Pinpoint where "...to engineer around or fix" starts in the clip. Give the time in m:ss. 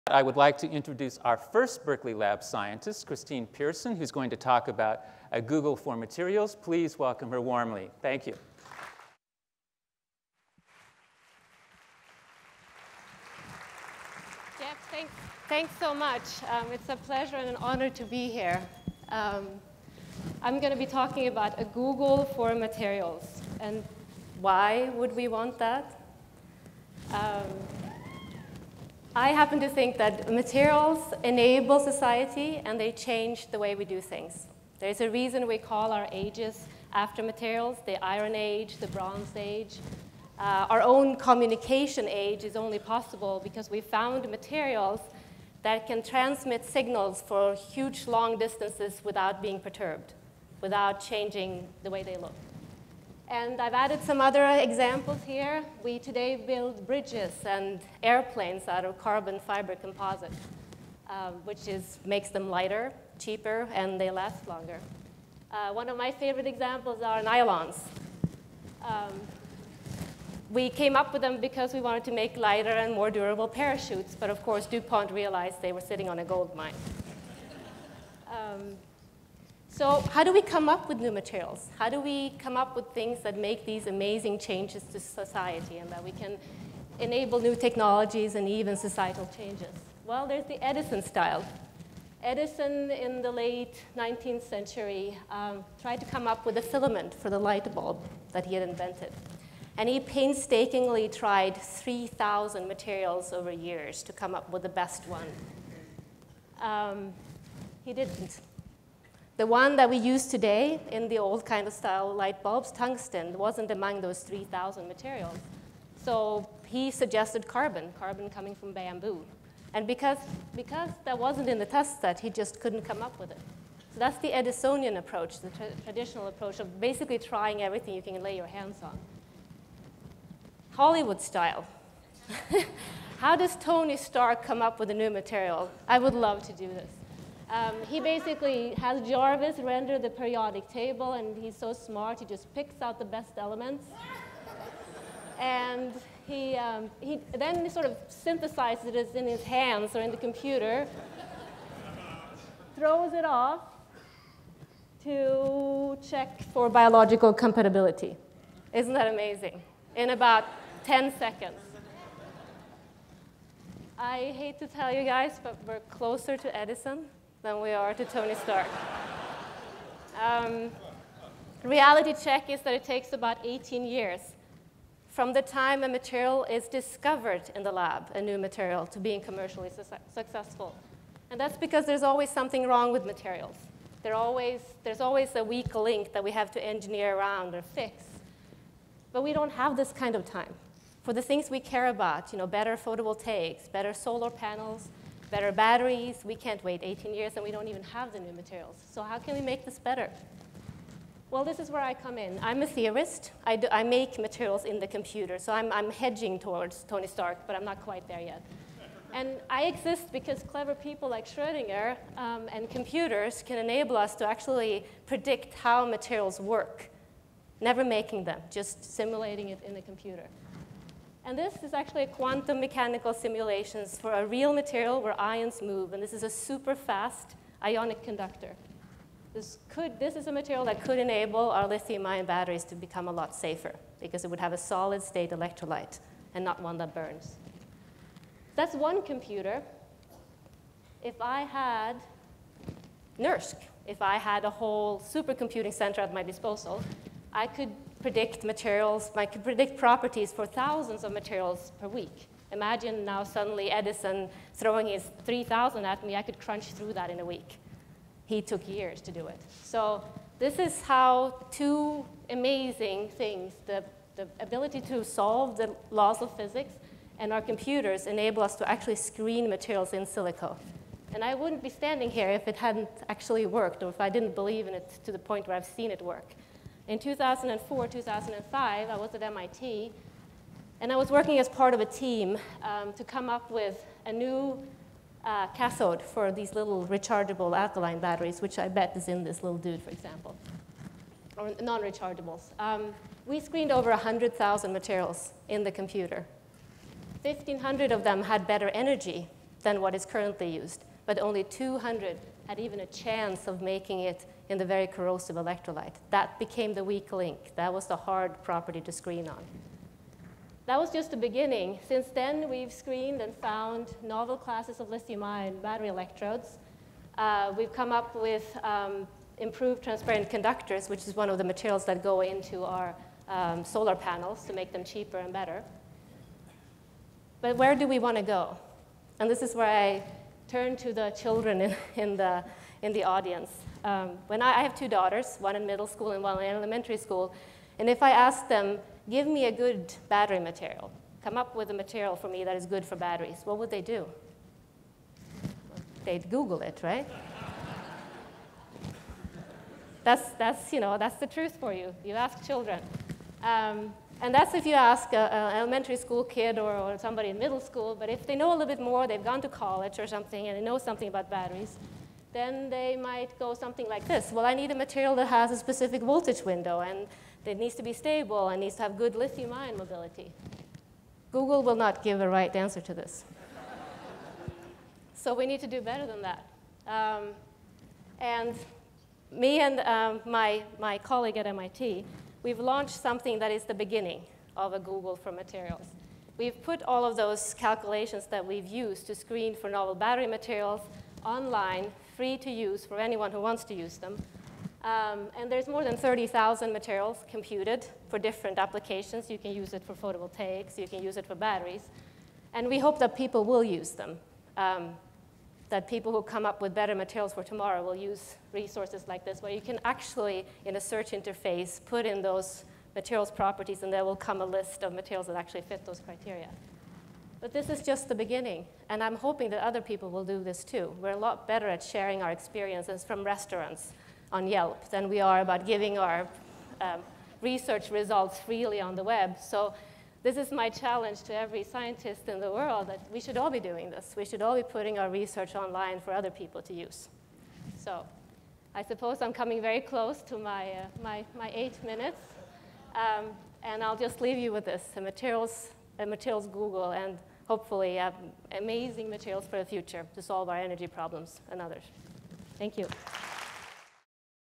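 3:06.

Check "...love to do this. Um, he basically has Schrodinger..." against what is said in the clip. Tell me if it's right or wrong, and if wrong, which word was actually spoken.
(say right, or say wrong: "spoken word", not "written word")
wrong: "Jarvis", not "Schrodinger".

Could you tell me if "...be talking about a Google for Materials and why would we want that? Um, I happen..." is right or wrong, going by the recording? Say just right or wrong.
right.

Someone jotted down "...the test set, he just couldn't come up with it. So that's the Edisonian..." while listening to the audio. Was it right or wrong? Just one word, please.
right.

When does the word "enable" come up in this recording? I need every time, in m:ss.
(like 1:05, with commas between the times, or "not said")
0:31, 1:26, 3:33, 3:50, 4:28.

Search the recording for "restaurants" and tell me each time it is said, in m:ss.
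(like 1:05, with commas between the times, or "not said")
7:03.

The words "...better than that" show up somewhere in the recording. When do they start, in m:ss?
6:15.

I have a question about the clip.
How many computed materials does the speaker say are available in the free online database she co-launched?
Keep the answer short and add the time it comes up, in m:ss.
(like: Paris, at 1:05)
30,000, at 6:35.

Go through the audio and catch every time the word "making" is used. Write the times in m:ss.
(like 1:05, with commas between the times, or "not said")
3:37, 5:03.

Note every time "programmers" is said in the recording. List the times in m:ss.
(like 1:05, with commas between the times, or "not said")
not said.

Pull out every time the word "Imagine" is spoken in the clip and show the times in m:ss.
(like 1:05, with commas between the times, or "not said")
4:12.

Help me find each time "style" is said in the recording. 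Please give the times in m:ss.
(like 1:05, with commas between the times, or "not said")
1:31, 1:51, 2:11.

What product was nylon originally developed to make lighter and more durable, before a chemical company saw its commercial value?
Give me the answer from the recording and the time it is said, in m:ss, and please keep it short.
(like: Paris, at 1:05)
Parachutes, at 1:13.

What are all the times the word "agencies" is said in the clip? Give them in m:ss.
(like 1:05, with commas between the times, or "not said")
not said.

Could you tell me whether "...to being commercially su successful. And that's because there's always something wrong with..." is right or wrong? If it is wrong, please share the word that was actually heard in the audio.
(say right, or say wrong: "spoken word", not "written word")
right.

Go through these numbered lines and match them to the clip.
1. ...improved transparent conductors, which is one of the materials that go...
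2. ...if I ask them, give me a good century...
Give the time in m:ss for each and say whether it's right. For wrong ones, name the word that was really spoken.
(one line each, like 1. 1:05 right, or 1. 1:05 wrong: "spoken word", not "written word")
1. 5:19 right
2. 5:37 wrong: "battery", not "century".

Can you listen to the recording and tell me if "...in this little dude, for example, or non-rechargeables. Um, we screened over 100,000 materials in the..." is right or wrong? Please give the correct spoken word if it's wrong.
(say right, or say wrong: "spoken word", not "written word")
right.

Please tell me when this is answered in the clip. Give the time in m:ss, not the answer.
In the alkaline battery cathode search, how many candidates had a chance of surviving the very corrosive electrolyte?
5:01.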